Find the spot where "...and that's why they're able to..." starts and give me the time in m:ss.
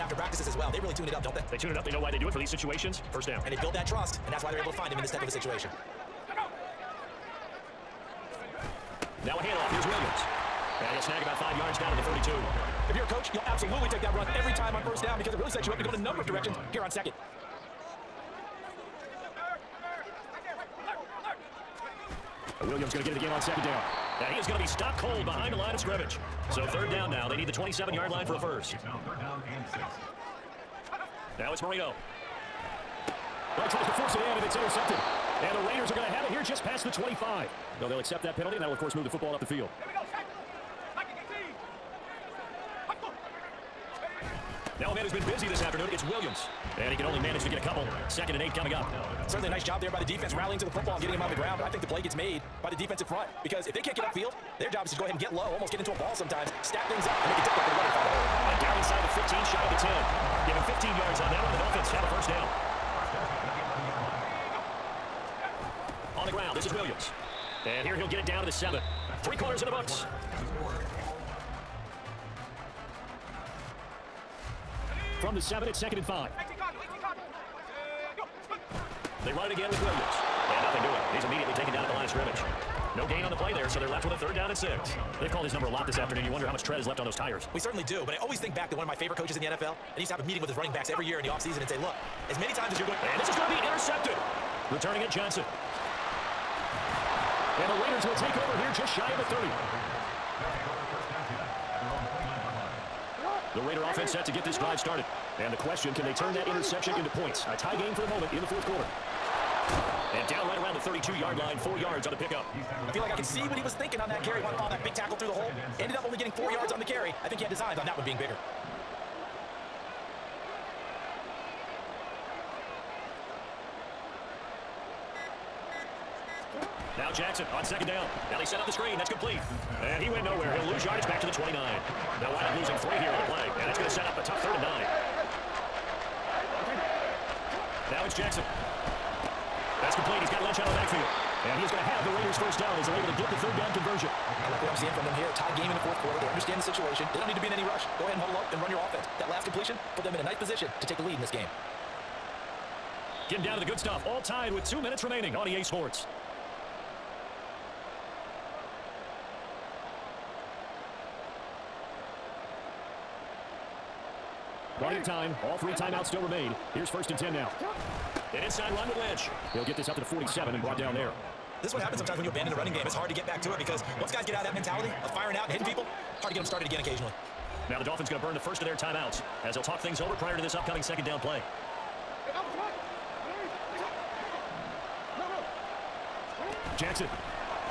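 0:04.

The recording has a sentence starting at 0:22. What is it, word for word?
Williams going to get it again on second down.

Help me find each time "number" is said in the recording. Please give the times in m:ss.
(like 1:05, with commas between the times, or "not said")
0:15, 1:25.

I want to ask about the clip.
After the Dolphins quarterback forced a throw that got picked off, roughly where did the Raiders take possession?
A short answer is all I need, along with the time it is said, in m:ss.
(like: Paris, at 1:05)
just past the 25, at 0:36.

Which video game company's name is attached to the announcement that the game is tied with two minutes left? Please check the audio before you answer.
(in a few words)
EA Sports.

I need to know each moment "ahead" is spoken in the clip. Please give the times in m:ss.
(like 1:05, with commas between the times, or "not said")
0:55, 2:28.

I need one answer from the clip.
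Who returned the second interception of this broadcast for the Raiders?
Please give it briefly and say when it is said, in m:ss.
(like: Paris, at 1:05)
Johnson, at 1:35.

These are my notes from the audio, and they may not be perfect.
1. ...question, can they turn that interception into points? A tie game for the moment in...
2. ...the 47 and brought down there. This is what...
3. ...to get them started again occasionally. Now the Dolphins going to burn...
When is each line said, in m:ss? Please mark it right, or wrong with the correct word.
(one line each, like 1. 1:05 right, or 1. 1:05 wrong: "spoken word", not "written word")
1. 1:45 right
2. 2:49 right
3. 2:56 right.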